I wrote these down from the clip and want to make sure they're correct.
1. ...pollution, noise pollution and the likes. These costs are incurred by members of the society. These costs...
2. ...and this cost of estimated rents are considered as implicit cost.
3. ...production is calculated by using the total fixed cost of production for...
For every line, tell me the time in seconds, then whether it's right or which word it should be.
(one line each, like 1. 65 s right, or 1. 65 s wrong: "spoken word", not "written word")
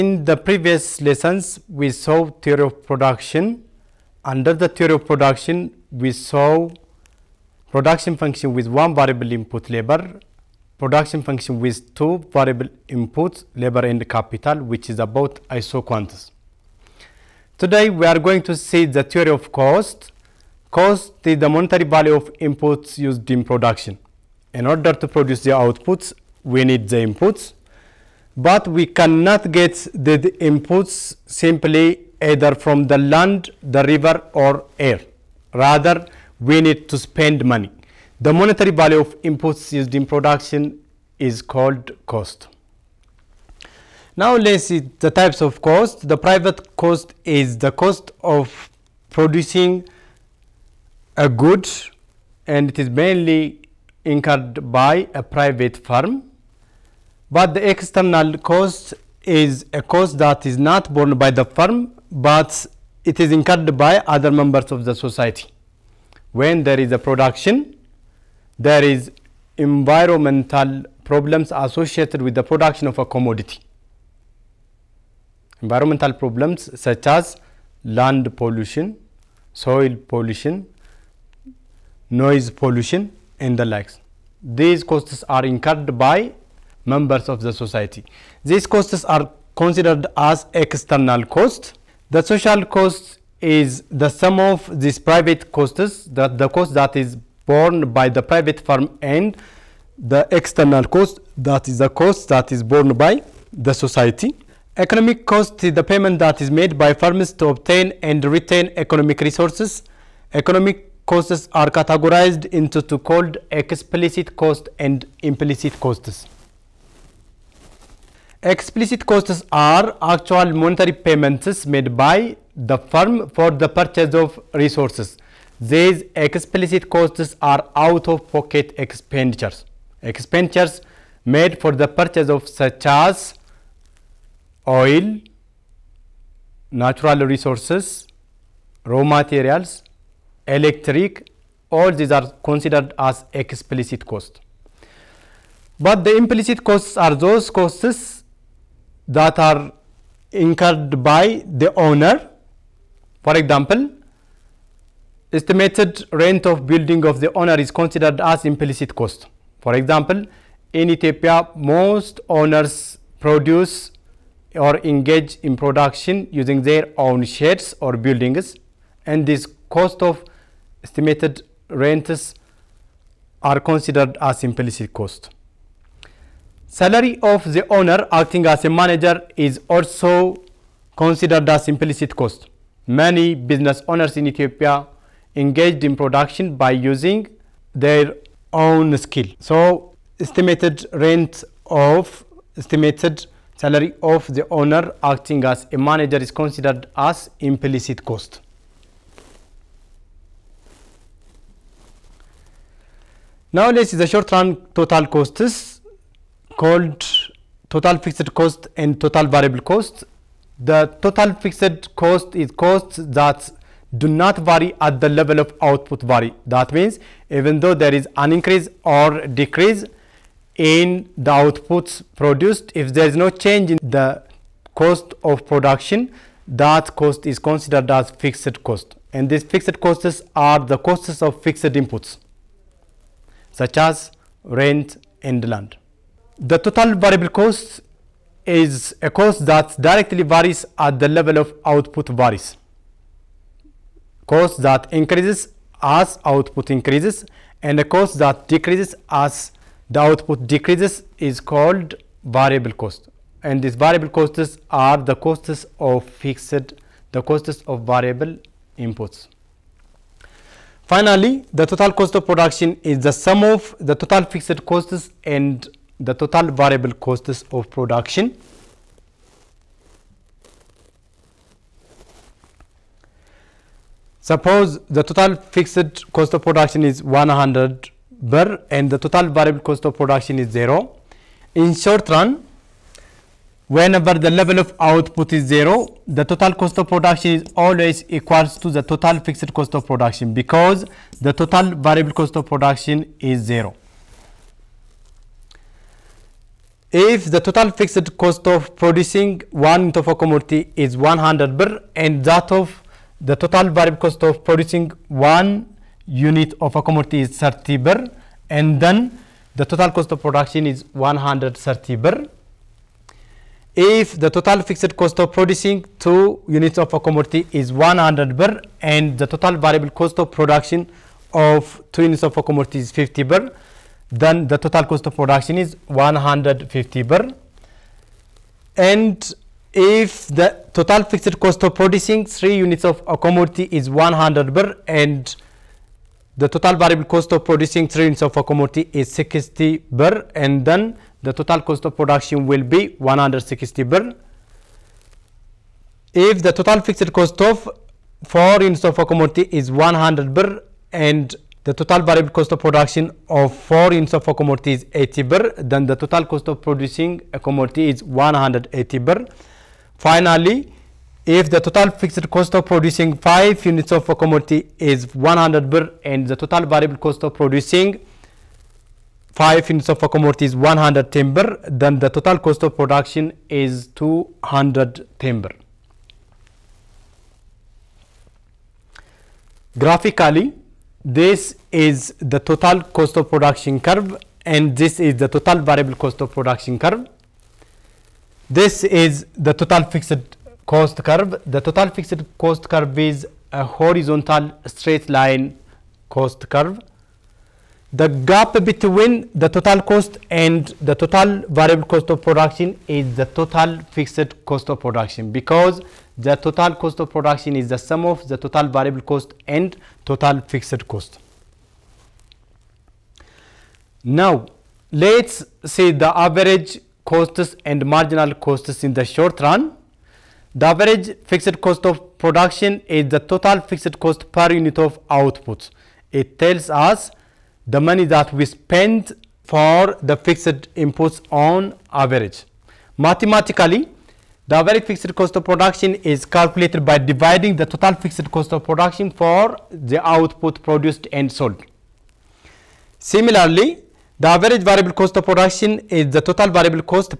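1. 80 s right
2. 169 s right
3. 435 s wrong: "dividing", not "using".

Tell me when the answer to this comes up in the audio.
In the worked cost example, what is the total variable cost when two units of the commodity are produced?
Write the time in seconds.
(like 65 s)
322 s.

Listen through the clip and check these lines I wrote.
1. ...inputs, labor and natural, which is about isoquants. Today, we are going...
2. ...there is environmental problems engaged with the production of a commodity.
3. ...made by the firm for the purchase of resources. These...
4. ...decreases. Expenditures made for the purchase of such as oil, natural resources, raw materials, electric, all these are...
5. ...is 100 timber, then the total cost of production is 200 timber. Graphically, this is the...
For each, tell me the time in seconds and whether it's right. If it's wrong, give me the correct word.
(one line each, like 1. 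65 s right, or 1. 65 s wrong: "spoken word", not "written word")
1. 12 s wrong: "capital", not "natural"
2. 68 s wrong: "associated", not "engaged"
3. 121 s right
4. 128 s wrong: "expenditures", not "decreases"
5. 370 s right.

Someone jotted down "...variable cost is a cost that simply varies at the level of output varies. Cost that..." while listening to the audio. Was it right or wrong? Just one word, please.
wrong.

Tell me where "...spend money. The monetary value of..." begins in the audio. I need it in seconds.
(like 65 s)
36 s.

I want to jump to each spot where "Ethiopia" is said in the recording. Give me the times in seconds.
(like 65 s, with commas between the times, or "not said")
160 s, 184 s.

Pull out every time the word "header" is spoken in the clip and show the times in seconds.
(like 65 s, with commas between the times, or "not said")
not said.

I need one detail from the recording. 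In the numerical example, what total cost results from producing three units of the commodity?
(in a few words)
160 birr.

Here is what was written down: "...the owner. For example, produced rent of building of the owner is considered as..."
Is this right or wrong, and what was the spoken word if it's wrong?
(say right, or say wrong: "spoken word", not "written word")
wrong: "estimated", not "produced".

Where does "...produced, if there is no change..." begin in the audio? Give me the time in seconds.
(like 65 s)
222 s.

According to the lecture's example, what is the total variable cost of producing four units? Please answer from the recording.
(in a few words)
80 birr.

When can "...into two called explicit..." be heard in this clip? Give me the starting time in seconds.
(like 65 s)
112 s.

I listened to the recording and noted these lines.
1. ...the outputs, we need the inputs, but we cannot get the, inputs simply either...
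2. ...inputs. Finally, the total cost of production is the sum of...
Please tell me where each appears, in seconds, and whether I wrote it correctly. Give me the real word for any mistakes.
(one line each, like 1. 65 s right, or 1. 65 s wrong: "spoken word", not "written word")
1. 25 s right
2. 258 s right.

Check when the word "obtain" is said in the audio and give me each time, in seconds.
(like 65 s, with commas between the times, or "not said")
107 s.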